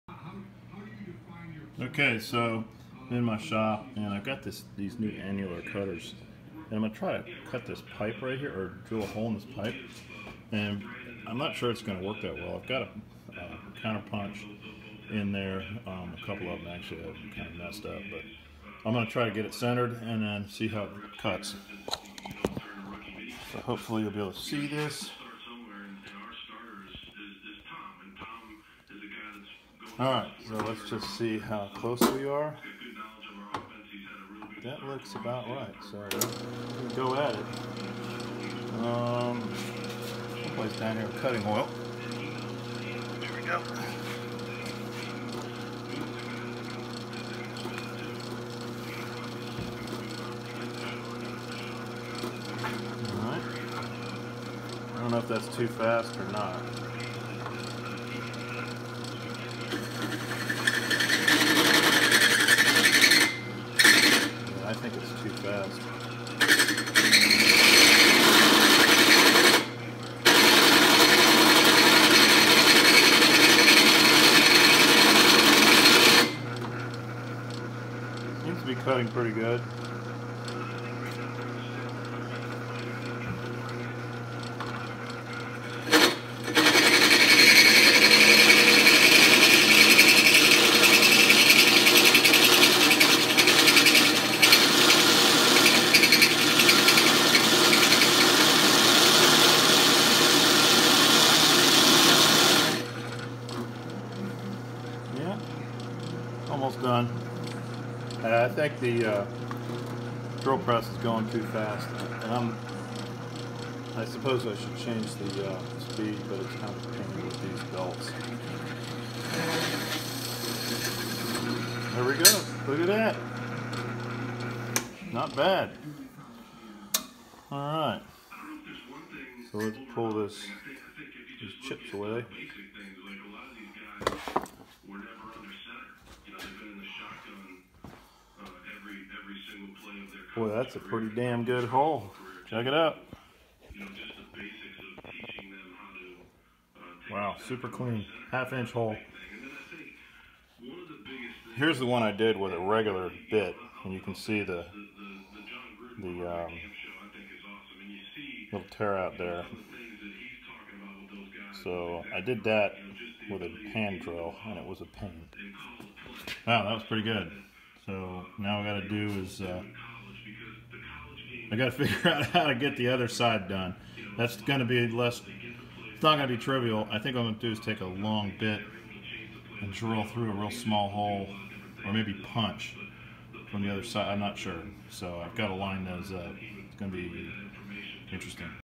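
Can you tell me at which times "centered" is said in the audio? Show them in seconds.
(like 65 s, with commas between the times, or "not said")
19 s.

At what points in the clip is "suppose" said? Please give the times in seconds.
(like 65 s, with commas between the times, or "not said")
114 s.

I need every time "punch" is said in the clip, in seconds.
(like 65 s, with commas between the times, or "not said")
14 s, 182 s.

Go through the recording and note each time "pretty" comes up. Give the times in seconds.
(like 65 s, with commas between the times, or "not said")
79 s, 140 s, 166 s.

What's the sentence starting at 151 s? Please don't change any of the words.
Here's the one I did with a regular bit, and you can see the the um, little tear out there.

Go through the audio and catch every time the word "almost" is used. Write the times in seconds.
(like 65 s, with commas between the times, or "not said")
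106 s.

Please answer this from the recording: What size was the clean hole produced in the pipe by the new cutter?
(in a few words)
half inch.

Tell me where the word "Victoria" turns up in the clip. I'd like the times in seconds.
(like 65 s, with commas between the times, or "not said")
not said.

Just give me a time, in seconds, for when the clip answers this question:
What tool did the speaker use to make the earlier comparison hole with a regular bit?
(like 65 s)
163 s.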